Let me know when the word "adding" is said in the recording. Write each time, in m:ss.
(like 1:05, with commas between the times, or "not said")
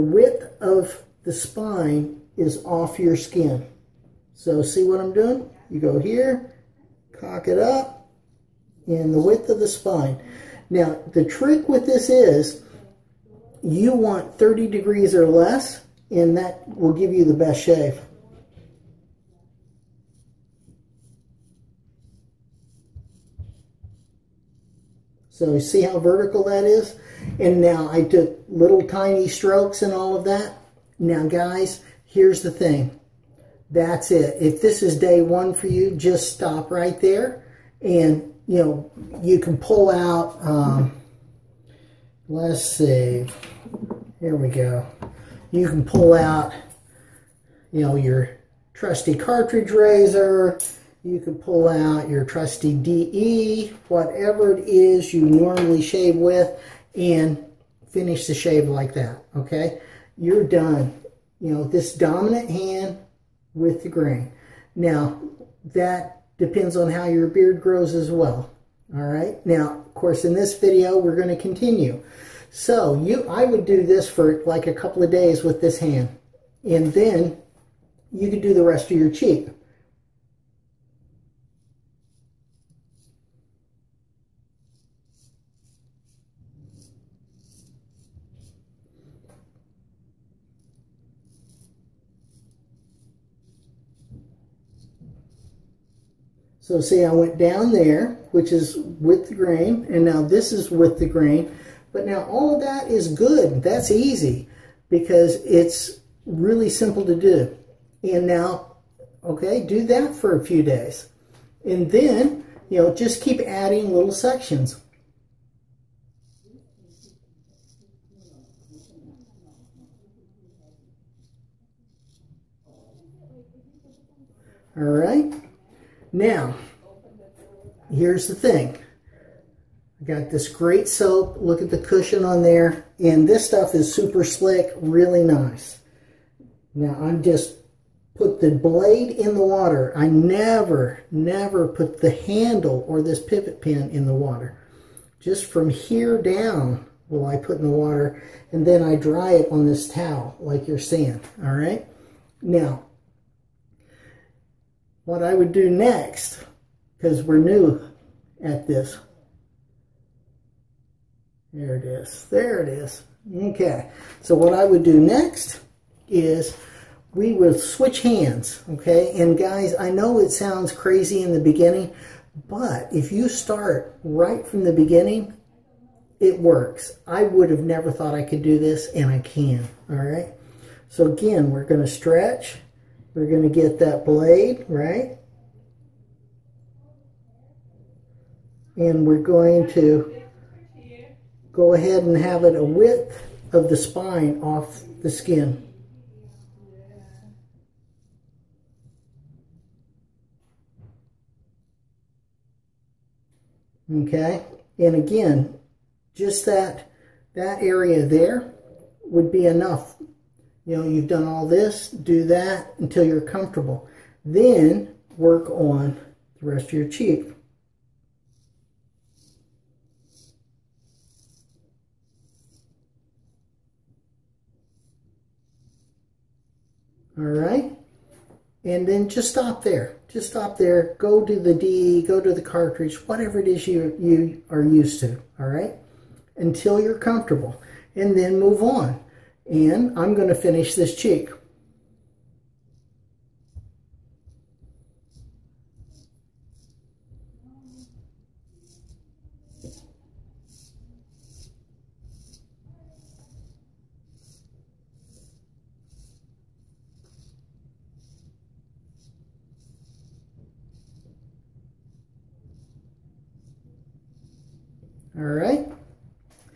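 1:53.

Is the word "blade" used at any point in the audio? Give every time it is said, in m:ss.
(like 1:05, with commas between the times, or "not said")
2:18, 3:04.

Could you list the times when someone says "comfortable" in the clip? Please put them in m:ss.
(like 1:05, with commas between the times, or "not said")
3:33, 3:56.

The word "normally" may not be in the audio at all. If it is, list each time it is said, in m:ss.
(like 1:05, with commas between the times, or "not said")
0:55.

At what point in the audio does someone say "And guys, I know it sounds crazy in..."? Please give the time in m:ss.
2:49.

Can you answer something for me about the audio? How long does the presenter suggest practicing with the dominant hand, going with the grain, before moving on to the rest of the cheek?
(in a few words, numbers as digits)
a couple of days.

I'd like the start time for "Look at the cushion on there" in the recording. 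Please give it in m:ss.
2:11.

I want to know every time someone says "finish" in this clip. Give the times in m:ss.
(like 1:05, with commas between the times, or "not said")
0:57, 4:00.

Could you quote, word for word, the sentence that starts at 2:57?
I would have never thought I could do this, and I can, all right?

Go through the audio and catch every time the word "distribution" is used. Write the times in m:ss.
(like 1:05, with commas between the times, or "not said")
not said.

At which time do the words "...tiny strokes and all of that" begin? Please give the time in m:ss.
0:28.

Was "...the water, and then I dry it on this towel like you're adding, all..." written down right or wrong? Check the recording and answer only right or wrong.
wrong.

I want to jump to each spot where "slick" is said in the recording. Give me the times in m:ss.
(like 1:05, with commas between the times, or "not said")
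2:14.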